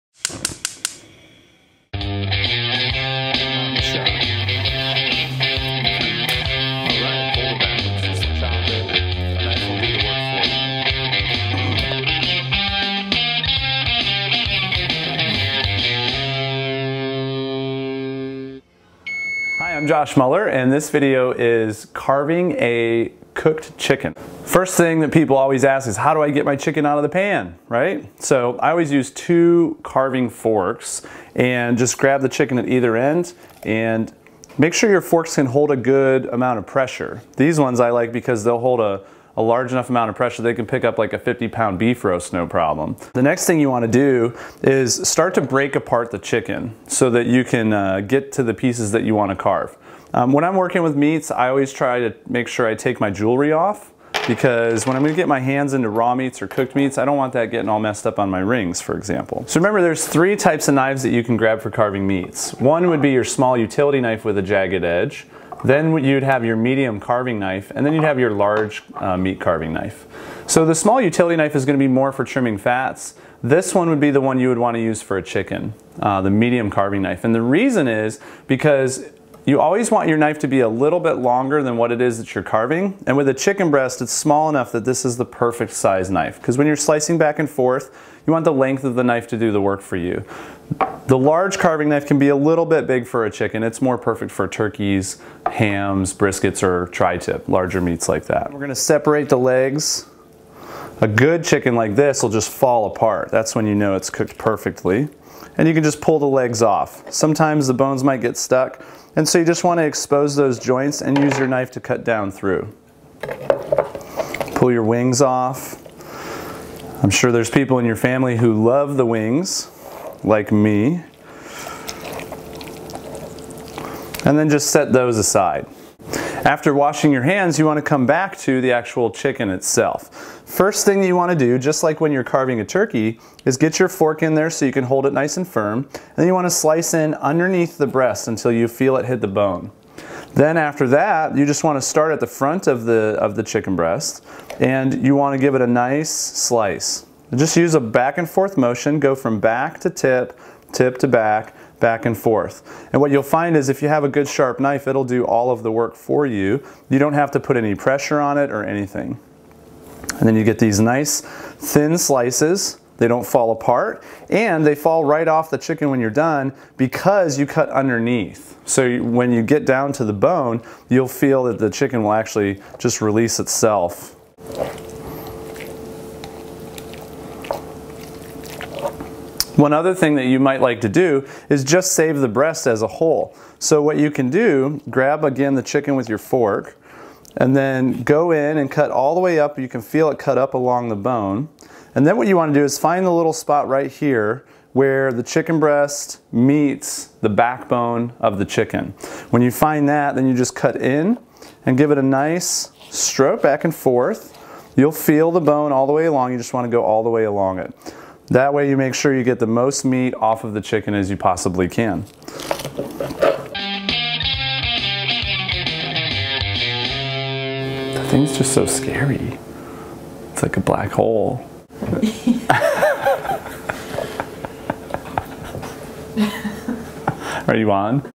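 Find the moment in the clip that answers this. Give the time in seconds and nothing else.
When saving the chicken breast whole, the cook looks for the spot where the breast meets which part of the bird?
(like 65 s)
197 s.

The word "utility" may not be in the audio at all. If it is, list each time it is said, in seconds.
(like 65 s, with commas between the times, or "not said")
63 s, 70 s.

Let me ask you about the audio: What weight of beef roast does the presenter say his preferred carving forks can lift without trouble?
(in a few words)
50 pounds.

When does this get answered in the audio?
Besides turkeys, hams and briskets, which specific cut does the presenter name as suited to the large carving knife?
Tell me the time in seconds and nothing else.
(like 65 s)
96 s.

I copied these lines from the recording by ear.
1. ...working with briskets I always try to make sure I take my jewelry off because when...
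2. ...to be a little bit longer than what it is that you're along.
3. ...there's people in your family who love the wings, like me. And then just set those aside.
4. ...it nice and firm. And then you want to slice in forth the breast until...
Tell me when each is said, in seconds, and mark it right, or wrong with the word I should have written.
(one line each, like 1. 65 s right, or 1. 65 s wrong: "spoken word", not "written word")
1. 50 s wrong: "meats", not "briskets"
2. 80 s wrong: "carving", not "along"
3. 117 s right
4. 135 s wrong: "underneath", not "forth".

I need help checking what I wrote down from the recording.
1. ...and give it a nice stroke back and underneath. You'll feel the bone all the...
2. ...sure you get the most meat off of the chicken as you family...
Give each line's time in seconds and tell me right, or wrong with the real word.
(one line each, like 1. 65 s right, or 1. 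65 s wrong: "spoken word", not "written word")
1. 201 s wrong: "forth", not "underneath"
2. 208 s wrong: "possibly", not "family".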